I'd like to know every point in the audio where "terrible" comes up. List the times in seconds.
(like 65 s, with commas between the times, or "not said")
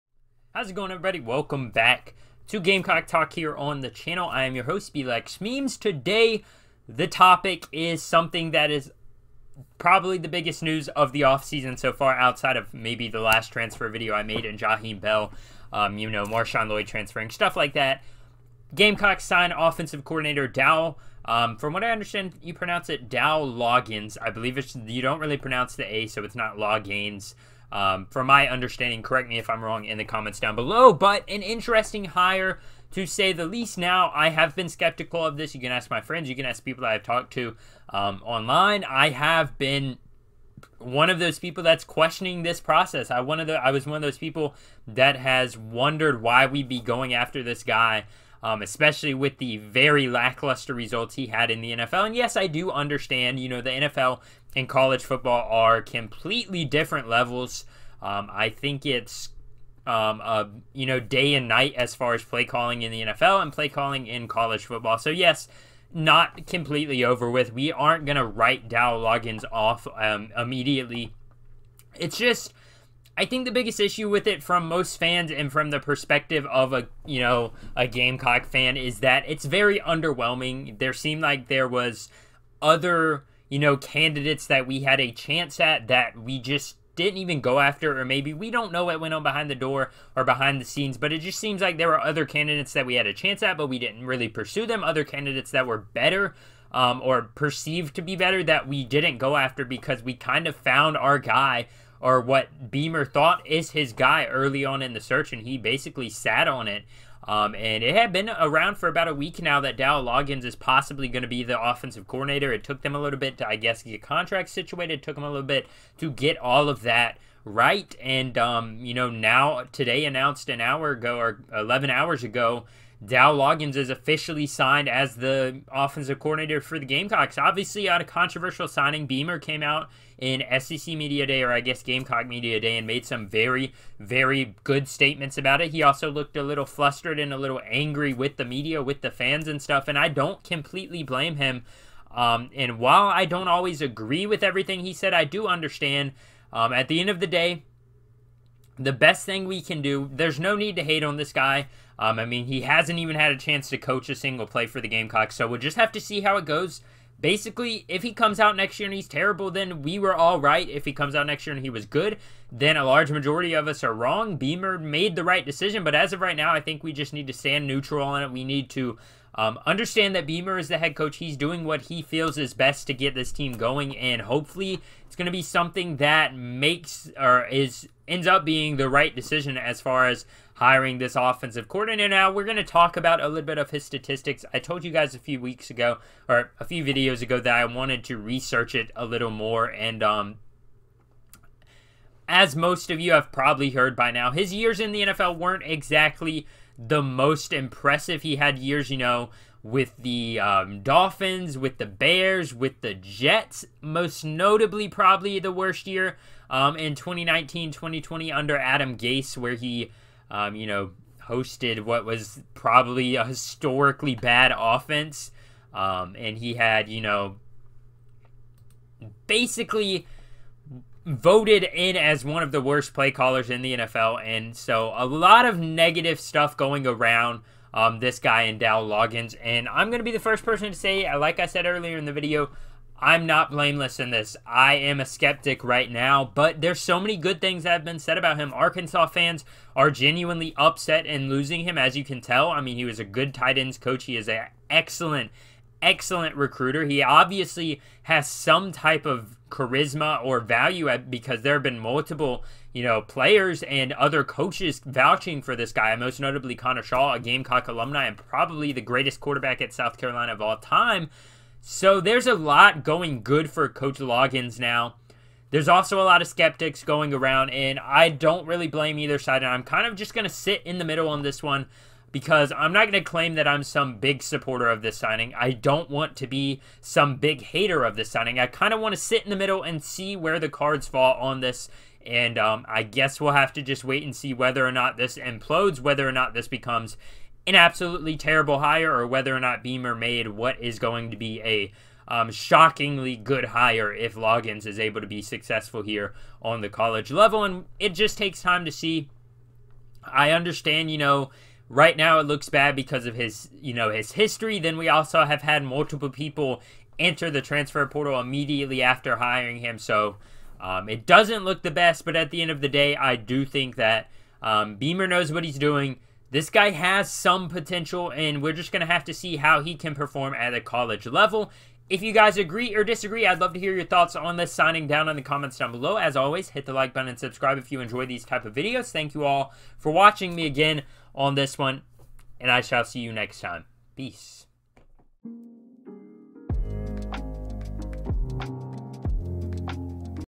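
159 s, 288 s.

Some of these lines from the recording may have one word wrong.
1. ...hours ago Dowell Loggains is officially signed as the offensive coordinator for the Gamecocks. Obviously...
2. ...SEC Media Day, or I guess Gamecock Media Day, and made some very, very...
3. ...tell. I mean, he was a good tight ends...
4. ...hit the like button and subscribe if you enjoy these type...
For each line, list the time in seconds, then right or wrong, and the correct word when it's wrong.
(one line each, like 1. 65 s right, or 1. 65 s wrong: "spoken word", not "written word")
1. 121 s right
2. 130 s right
3. 242 s right
4. 326 s right.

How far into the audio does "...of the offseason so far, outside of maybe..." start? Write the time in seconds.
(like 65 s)
10 s.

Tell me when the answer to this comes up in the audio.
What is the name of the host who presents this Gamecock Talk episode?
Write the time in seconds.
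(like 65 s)
4 s.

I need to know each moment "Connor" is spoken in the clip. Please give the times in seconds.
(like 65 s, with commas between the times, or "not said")
256 s.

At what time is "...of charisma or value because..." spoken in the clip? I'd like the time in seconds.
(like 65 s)
249 s.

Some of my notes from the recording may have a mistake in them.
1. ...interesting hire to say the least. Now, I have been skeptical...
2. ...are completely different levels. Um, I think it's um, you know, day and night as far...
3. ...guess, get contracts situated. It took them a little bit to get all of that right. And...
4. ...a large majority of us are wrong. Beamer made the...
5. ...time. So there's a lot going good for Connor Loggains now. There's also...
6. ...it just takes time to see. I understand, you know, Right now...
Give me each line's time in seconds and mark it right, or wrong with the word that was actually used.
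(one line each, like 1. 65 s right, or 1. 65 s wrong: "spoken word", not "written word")
1. 31 s right
2. 55 s right
3. 113 s right
4. 162 s right
5. 260 s wrong: "Coach", not "Connor"
6. 297 s right.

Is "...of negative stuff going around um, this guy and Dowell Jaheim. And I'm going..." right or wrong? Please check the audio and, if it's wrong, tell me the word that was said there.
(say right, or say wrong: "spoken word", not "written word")
wrong: "Loggains", not "Jaheim".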